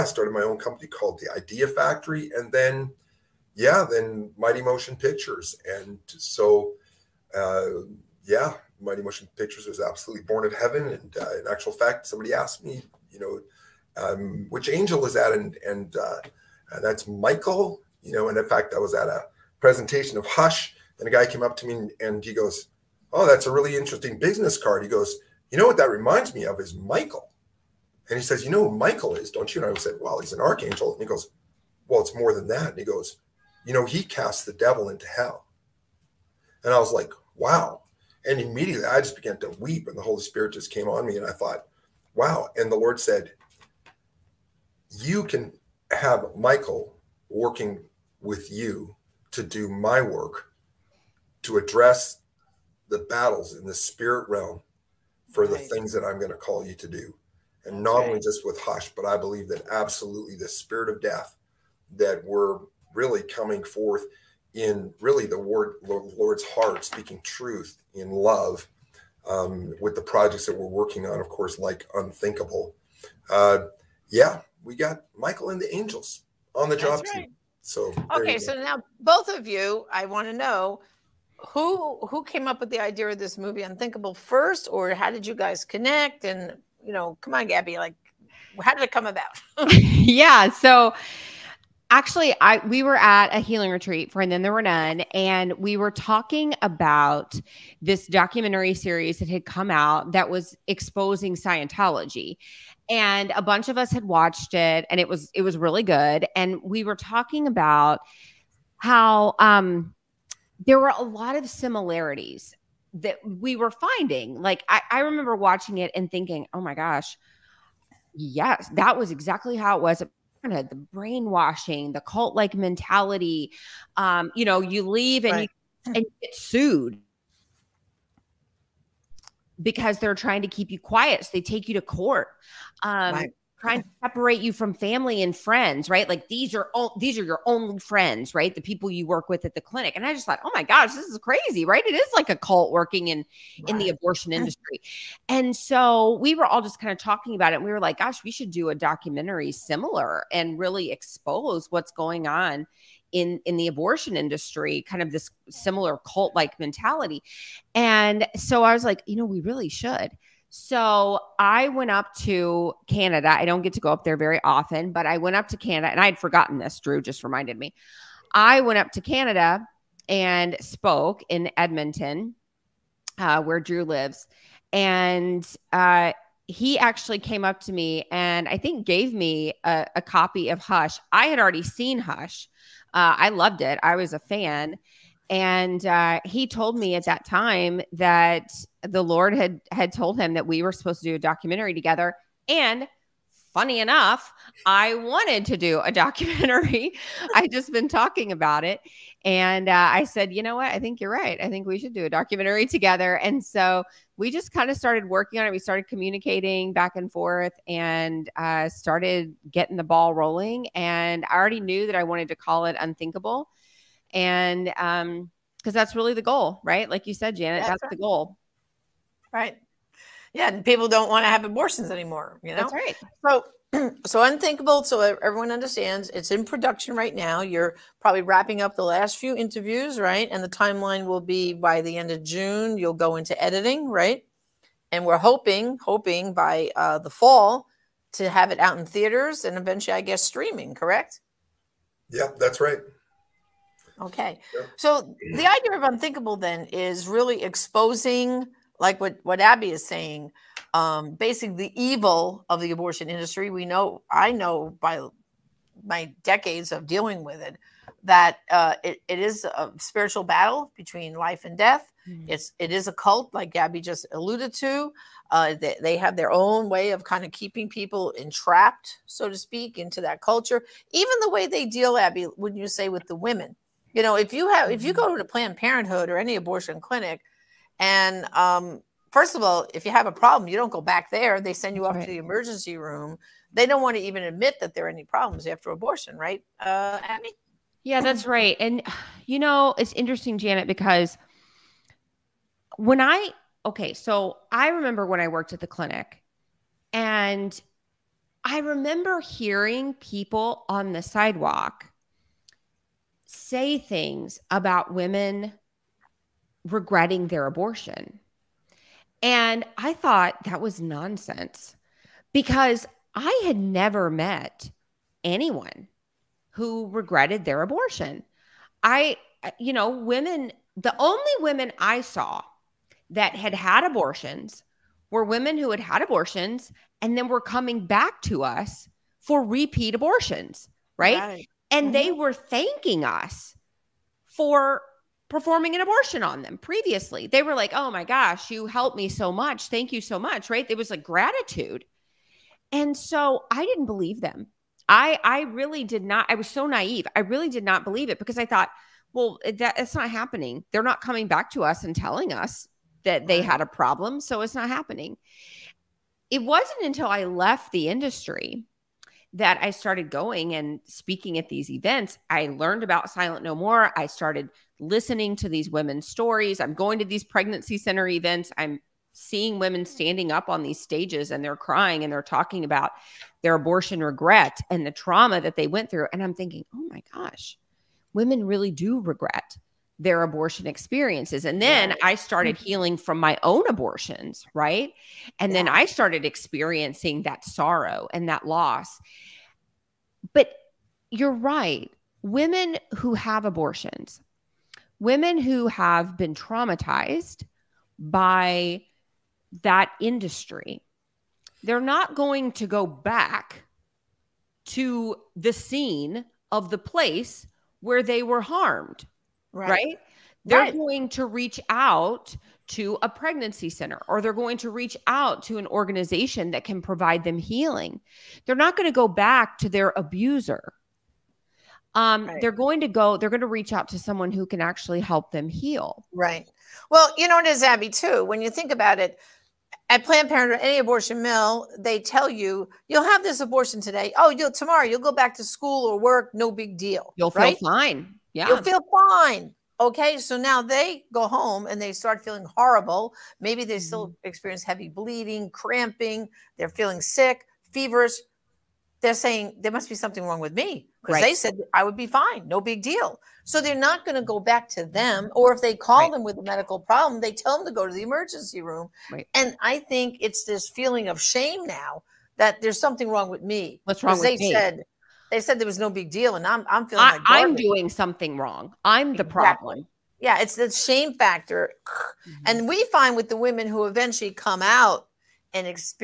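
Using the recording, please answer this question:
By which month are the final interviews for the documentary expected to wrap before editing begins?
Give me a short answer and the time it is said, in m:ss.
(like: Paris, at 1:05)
June, at 3:52.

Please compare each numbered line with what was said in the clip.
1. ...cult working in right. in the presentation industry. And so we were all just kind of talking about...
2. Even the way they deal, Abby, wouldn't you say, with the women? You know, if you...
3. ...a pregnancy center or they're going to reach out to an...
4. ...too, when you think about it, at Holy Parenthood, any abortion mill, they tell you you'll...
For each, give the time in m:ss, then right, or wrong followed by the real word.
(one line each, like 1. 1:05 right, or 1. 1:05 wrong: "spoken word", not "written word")
1. 2:22 wrong: "abortion", not "presentation"
2. 4:30 right
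3. 6:53 right
4. 7:07 wrong: "Planned", not "Holy".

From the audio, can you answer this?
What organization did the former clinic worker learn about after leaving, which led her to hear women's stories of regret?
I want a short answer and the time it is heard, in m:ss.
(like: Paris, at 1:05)
Silent No More, at 6:03.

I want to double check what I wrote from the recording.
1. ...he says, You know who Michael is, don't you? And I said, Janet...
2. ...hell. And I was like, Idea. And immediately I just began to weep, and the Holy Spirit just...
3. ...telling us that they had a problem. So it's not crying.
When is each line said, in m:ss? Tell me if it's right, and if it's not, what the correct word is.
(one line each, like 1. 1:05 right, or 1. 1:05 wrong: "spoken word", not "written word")
1. 0:28 wrong: "Well", not "Janet"
2. 0:35 wrong: "Wow", not "Idea"
3. 5:51 wrong: "happening", not "crying".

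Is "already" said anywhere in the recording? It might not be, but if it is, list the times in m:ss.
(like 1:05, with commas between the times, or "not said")
3:01, 3:31.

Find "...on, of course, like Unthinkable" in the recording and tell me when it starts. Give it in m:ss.
1:11.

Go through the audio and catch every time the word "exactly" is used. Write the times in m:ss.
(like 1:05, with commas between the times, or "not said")
1:59, 7:49.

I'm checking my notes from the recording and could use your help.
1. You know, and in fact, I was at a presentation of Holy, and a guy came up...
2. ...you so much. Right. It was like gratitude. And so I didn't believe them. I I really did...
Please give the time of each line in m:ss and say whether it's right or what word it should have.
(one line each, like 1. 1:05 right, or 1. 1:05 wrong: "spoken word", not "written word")
1. 0:18 wrong: "Hush", not "Holy"
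2. 5:39 right.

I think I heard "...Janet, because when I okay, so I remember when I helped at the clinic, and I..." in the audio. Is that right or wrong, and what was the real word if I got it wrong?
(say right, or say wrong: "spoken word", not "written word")
wrong: "worked", not "helped".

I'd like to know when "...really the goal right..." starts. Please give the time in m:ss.
3:35.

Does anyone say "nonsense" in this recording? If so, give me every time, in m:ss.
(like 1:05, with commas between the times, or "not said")
5:10.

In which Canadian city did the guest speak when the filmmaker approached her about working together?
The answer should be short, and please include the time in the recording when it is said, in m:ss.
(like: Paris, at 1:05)
Edmonton, at 2:51.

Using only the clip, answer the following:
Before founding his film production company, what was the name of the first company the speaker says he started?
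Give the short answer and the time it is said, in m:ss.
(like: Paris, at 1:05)
the Idea Factory, at 0:01.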